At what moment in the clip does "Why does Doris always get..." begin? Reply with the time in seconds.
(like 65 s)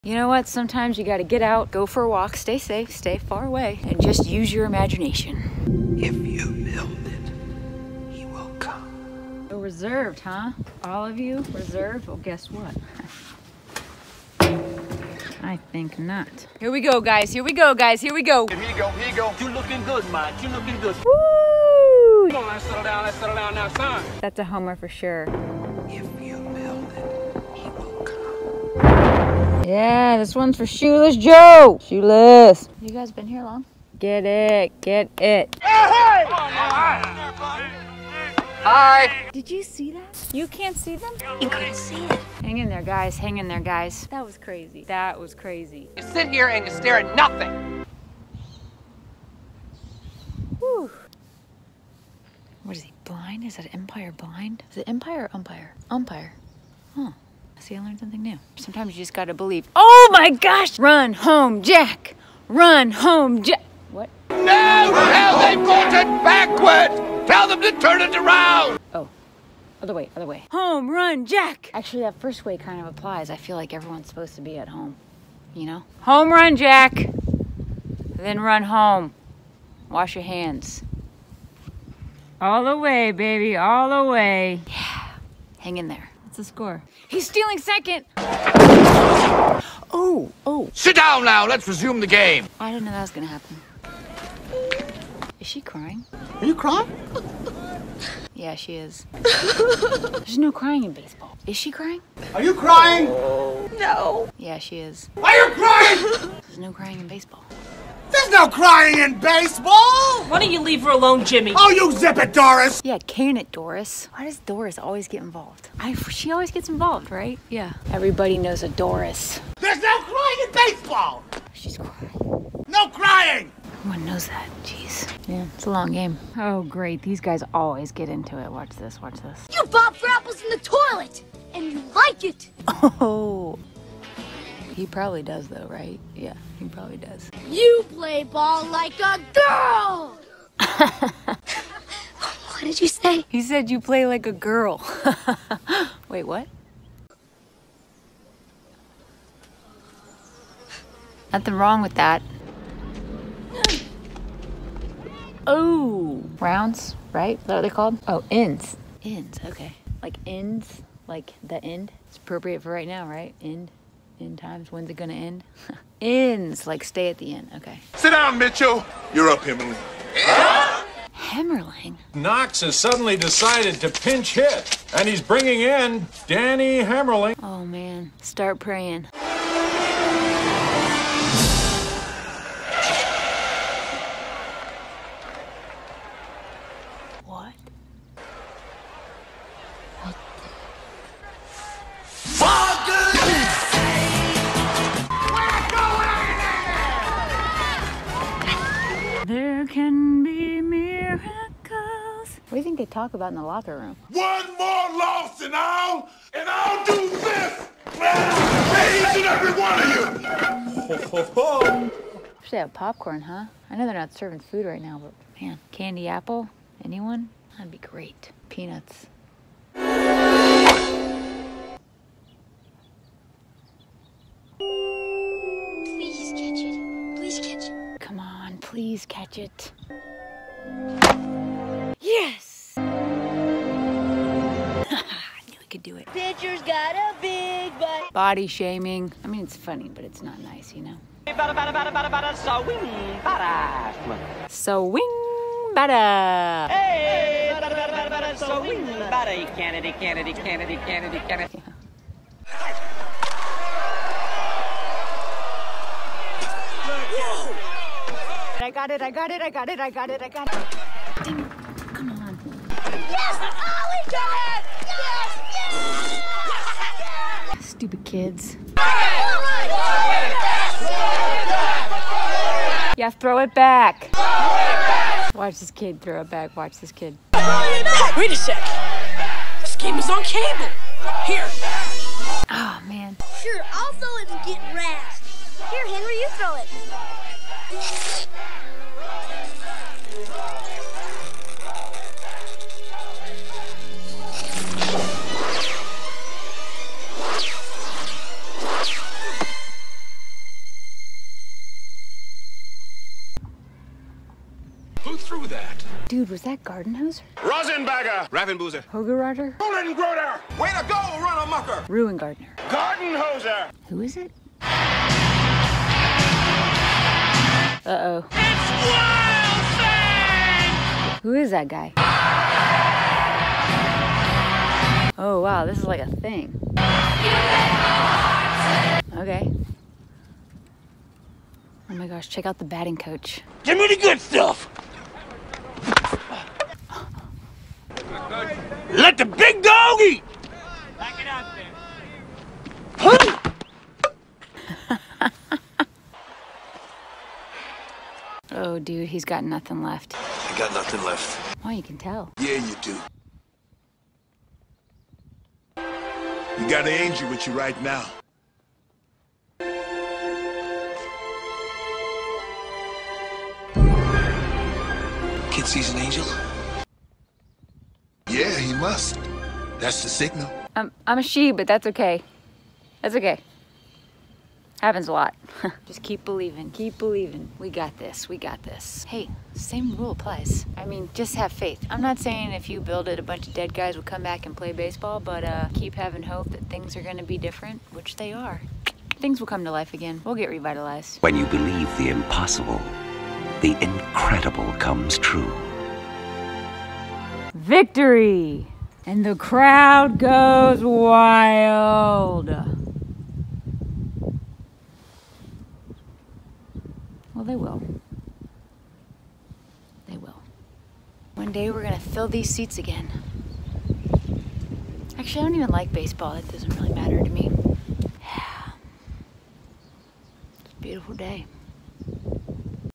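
114 s.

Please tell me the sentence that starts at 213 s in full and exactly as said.
I know they're not serving food right now, but man, candy apple?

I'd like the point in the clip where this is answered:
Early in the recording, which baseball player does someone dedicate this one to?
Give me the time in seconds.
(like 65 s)
30 s.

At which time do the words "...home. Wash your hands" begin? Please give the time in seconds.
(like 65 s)
78 s.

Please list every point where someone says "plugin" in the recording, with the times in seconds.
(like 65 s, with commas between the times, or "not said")
not said.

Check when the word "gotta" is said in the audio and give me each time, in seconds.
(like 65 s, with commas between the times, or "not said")
1 s, 59 s.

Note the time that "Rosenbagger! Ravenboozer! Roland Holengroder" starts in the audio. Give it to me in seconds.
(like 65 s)
307 s.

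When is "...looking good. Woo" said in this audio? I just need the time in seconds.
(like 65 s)
20 s.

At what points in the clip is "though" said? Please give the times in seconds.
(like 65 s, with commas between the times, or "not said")
135 s.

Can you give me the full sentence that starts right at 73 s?
I feel like everyone's supposed to be at home.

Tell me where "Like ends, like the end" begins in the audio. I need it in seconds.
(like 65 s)
160 s.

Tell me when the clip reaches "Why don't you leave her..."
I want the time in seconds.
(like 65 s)
110 s.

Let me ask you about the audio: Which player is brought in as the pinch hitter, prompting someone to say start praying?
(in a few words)
Danny Hemmerling.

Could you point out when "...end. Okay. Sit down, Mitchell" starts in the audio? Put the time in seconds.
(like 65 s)
167 s.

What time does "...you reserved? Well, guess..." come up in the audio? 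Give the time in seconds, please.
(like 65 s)
11 s.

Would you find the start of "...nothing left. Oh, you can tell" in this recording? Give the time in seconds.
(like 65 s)
350 s.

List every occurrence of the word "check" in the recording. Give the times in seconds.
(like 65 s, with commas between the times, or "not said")
332 s.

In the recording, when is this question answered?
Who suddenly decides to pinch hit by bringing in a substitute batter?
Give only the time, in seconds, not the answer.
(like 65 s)
172 s.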